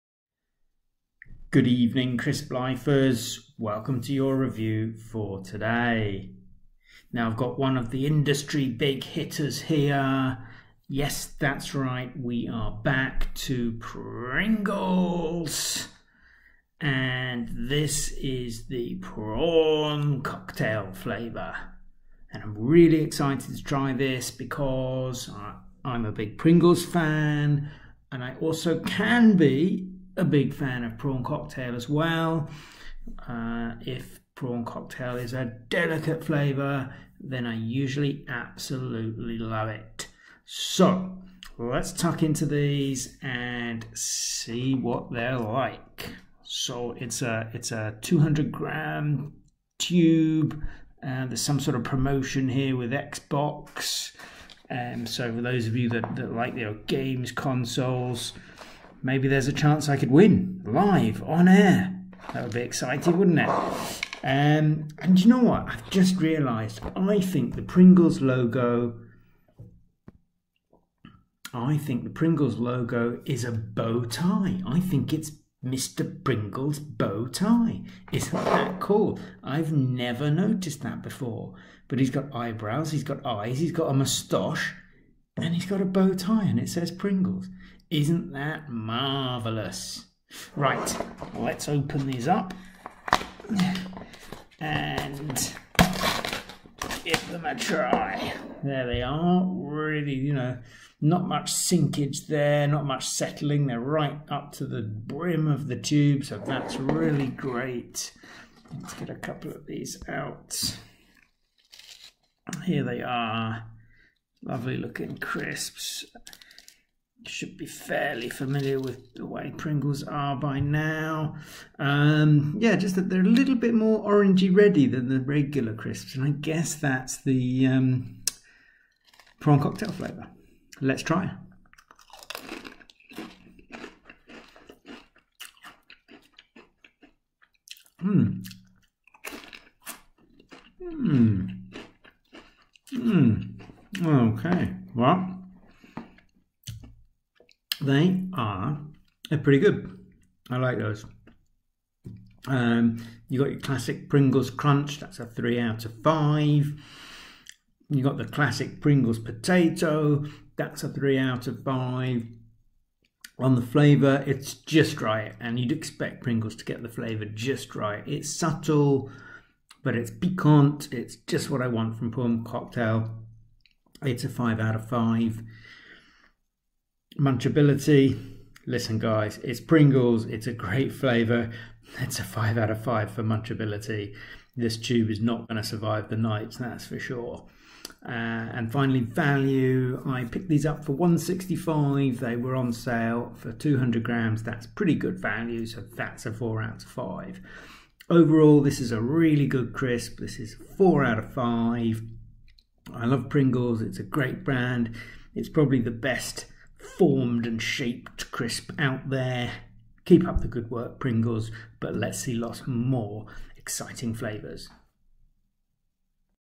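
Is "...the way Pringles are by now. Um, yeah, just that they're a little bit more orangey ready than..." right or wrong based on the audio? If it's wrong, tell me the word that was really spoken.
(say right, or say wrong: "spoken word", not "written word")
right.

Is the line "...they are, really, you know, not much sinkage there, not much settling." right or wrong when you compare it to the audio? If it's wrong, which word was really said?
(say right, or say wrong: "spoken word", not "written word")
right.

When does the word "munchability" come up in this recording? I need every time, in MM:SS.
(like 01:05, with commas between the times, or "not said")
02:57, 03:03.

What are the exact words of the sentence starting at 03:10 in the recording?
I picked these up for 165.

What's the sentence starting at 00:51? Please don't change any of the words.
Uh, there's some sort of promotion here with Xbox.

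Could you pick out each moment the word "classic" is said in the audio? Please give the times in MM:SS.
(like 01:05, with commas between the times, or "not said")
02:33, 02:38.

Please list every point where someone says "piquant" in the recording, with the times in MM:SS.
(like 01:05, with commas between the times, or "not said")
02:50.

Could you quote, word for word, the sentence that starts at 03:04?
This tube is not going to survive the night, that's for sure.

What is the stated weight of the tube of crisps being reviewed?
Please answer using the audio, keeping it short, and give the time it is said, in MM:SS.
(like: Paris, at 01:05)
200 grams, at 00:48.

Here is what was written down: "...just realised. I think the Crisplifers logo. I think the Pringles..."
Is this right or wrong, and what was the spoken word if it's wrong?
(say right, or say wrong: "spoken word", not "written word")
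wrong: "Pringles", not "Crisplifers".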